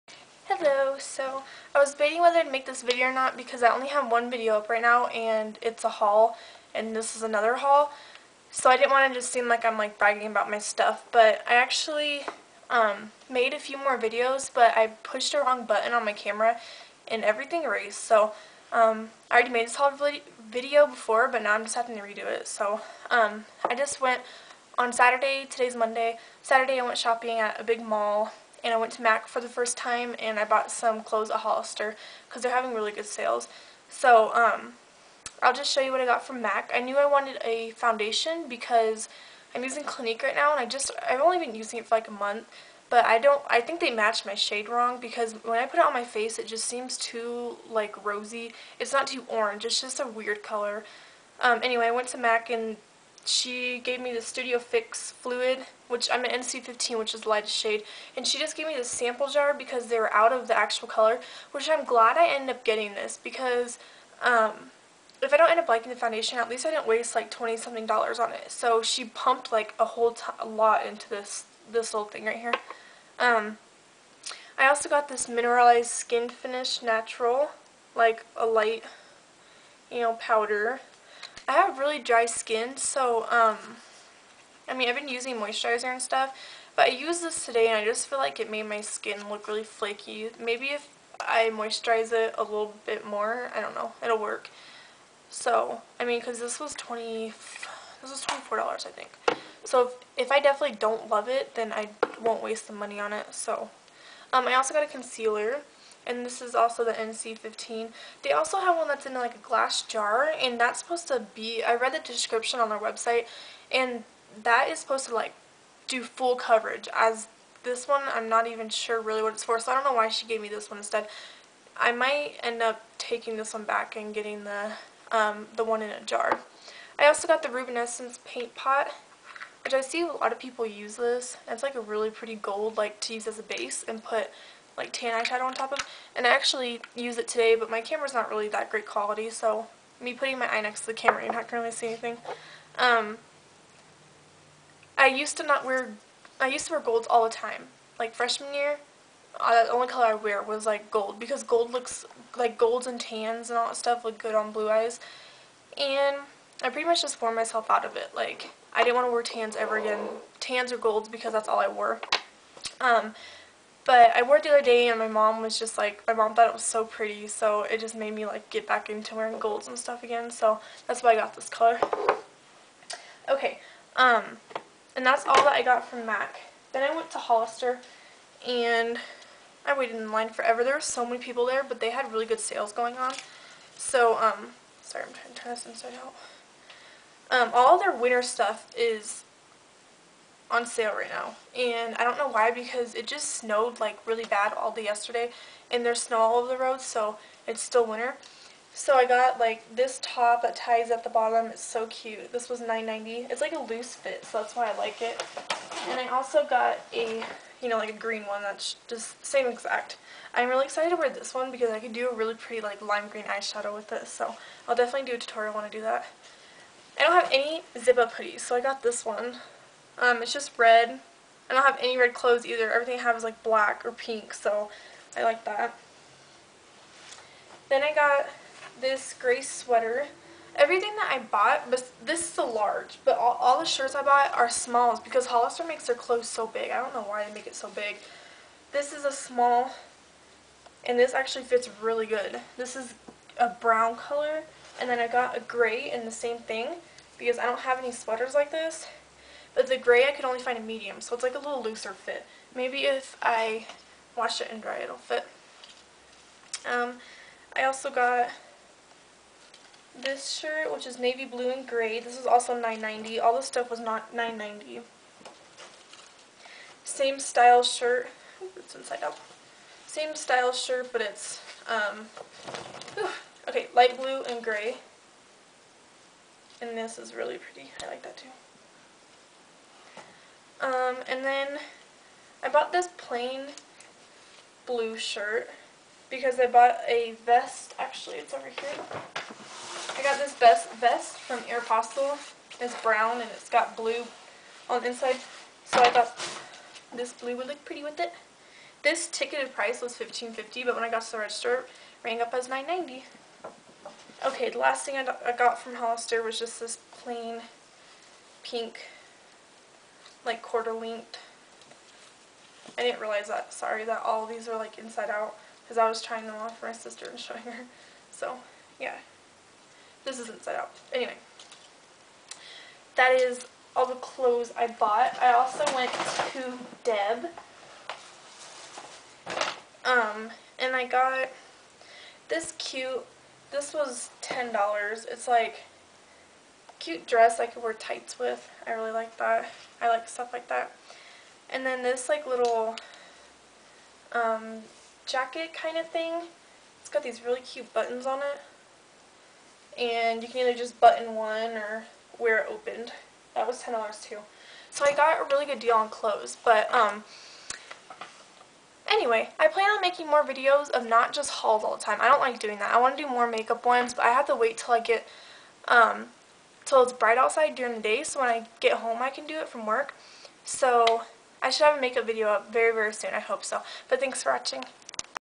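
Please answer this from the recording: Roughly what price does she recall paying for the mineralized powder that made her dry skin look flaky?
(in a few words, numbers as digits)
$24.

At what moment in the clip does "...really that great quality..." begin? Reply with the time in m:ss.
2:18.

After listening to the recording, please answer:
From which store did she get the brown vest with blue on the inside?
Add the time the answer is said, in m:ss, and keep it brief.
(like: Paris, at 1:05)
Aeropostale, at 4:51.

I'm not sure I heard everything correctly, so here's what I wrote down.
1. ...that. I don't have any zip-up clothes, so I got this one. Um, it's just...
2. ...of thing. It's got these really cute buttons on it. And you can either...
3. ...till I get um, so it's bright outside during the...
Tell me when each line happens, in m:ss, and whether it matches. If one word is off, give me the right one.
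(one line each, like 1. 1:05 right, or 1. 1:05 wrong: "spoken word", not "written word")
1. 3:35 wrong: "hoodies", not "clothes"
2. 5:45 right
3. 6:04 right.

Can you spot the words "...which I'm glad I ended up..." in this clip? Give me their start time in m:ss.
1:01.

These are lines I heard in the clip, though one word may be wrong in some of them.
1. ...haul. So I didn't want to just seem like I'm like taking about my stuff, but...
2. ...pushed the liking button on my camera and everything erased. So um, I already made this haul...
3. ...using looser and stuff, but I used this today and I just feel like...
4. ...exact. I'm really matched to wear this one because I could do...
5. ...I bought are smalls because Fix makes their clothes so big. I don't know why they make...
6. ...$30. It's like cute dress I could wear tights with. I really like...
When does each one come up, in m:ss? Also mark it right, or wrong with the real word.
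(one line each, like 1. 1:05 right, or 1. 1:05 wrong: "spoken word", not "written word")
1. 0:07 wrong: "bragging", not "taking"
2. 0:15 wrong: "wrong", not "liking"
3. 1:25 wrong: "moisturizer", not "looser"
4. 3:29 wrong: "excited", not "matched"
5. 3:53 wrong: "Hollister", not "Fix"
6. 5:34 wrong: "10", not "30".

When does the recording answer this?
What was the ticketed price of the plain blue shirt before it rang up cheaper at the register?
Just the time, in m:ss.
4:59.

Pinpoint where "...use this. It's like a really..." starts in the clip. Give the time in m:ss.
2:10.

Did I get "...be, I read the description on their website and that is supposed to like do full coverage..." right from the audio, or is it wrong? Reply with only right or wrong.
right.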